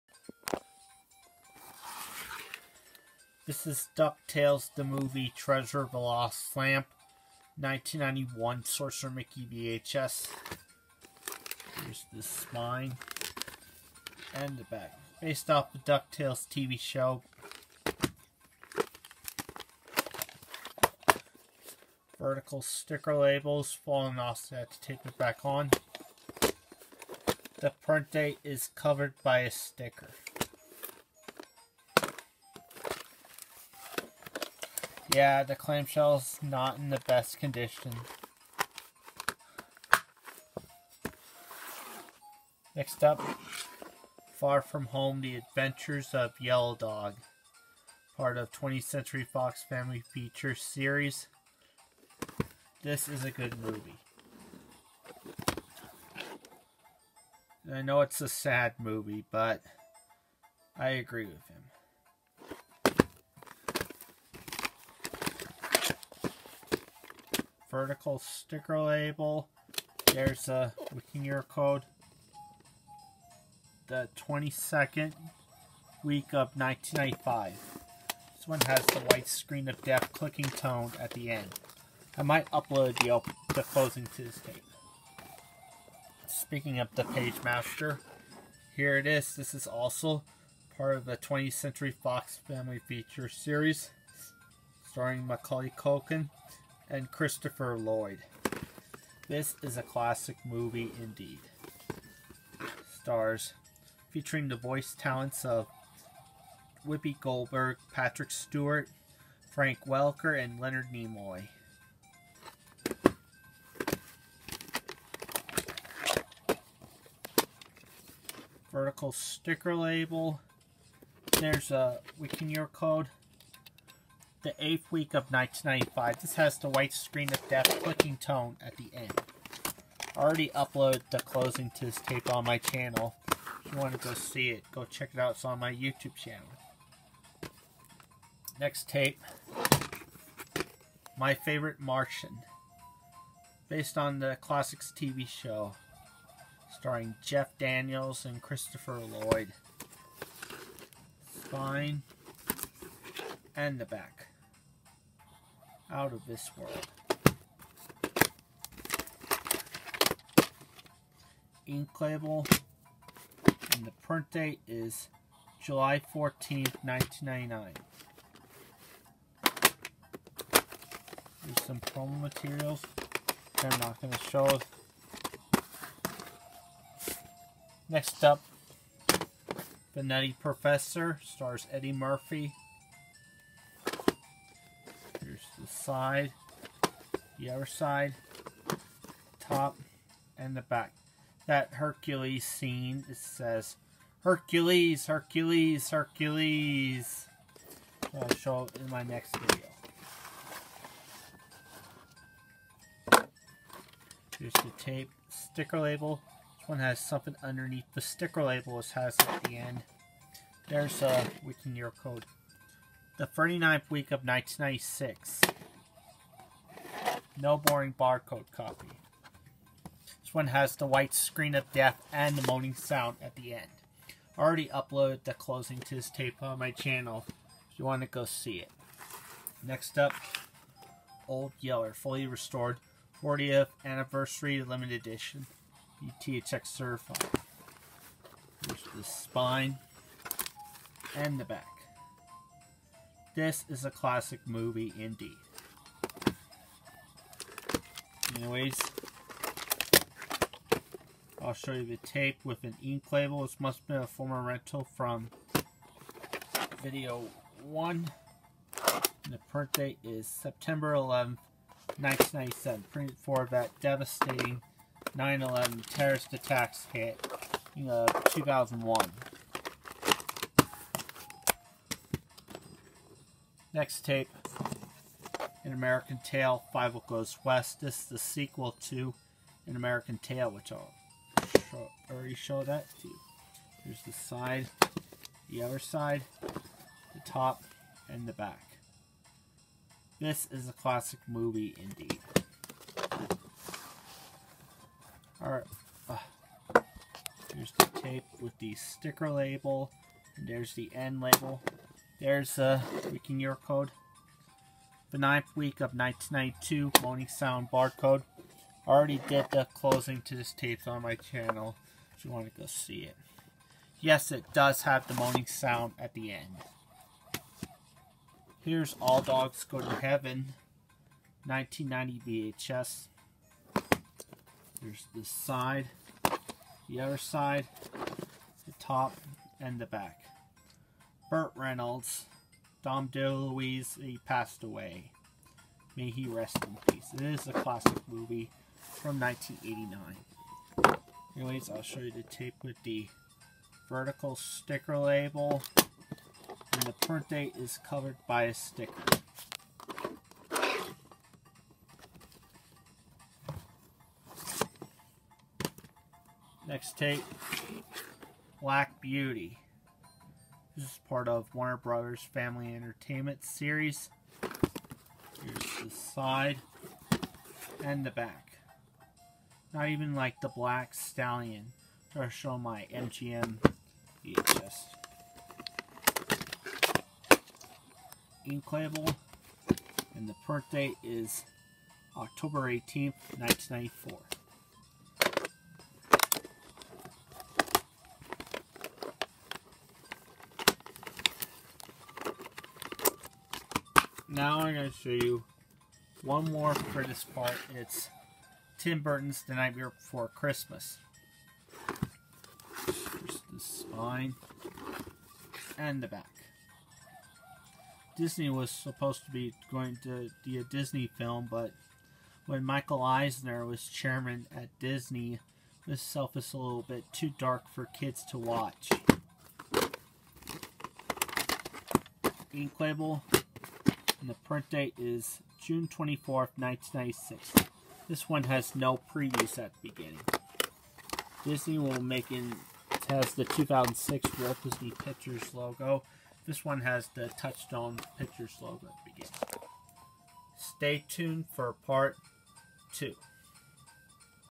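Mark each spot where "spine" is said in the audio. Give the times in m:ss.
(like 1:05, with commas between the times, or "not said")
0:12, 2:31, 3:59, 6:43.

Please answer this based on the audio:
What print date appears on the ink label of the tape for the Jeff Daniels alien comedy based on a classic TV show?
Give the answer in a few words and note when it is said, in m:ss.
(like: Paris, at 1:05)
July 14, 1999, at 2:45.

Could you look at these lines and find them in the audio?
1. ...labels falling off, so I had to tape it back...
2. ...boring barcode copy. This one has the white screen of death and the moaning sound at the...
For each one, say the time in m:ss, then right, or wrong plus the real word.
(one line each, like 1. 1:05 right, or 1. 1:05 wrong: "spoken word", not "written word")
1. 0:23 right
2. 3:37 right.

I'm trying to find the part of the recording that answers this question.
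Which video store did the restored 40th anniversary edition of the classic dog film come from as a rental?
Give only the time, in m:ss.
4:16.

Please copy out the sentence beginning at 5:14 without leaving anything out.
Yes, it does have the moaning sound at the end.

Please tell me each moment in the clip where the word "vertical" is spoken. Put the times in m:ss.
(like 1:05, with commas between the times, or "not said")
0:22, 1:07, 1:58, 5:43.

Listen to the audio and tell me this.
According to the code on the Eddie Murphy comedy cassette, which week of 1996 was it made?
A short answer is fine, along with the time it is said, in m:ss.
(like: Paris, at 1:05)
39th week, at 3:33.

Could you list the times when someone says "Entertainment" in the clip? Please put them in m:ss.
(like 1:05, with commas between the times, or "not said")
6:02.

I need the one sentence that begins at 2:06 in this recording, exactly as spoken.
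This has the white screen of death clicking tone at the end.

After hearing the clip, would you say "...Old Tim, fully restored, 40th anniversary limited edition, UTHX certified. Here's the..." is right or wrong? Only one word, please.
wrong.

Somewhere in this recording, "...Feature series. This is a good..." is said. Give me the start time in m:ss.
0:50.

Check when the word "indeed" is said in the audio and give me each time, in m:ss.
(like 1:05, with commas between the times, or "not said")
1:41, 4:04, 4:51.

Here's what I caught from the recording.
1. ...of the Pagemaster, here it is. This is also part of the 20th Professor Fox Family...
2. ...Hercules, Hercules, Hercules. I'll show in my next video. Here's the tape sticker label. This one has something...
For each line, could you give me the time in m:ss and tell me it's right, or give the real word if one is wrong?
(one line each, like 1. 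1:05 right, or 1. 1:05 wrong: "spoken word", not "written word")
1. 1:26 wrong: "Century", not "Professor"
2. 3:14 right.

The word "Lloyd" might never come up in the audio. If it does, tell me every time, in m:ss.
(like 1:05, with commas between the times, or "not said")
1:37, 2:28.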